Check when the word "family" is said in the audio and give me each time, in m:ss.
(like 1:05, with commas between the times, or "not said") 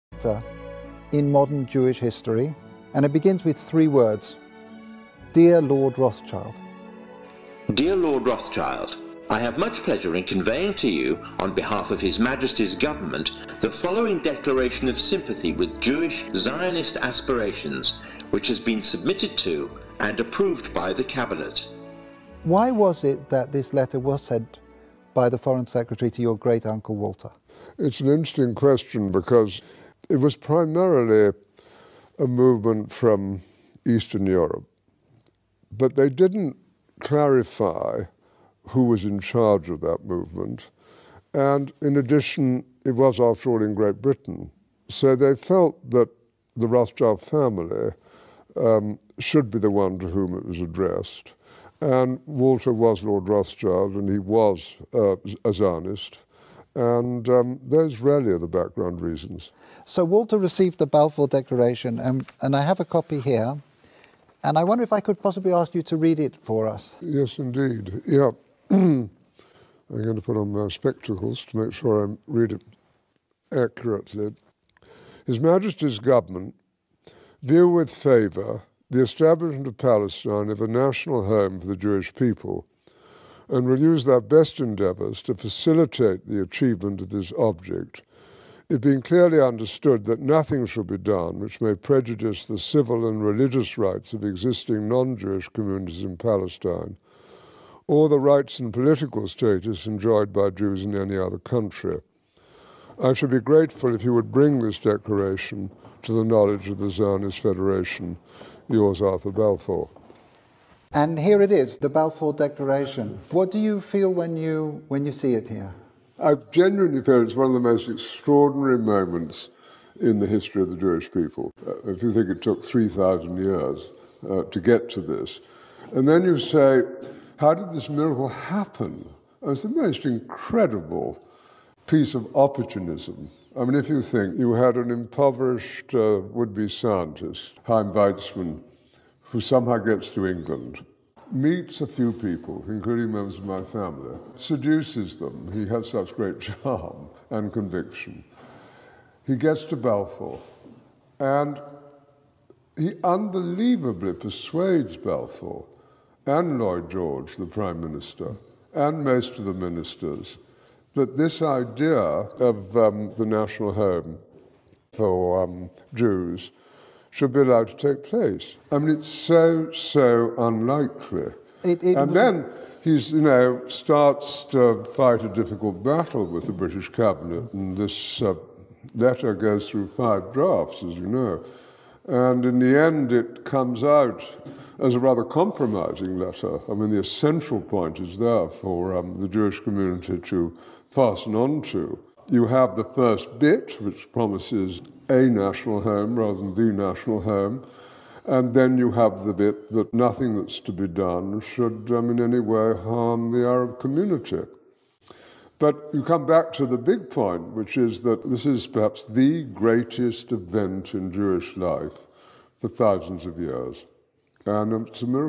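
0:47, 2:23.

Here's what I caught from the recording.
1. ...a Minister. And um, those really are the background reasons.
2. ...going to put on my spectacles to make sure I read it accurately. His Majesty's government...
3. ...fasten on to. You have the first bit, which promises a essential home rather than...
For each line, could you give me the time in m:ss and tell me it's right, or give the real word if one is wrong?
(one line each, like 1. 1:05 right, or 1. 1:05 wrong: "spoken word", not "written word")
1. 0:55 wrong: "Zionist", not "Minister"
2. 1:09 right
3. 3:10 wrong: "national", not "essential".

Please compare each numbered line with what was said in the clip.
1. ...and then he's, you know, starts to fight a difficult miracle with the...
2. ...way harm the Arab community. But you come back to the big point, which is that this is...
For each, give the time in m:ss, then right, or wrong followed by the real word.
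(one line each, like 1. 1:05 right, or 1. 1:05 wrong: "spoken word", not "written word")
1. 2:51 wrong: "battle", not "miracle"
2. 3:22 right.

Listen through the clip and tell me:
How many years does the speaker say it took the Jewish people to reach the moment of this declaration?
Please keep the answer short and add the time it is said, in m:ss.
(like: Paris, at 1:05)
3,000, at 2:02.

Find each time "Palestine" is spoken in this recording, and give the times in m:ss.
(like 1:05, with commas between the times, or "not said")
1:19, 1:36.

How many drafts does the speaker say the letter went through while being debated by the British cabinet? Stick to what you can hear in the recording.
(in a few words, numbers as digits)
5.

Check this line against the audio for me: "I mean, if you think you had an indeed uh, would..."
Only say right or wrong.
wrong.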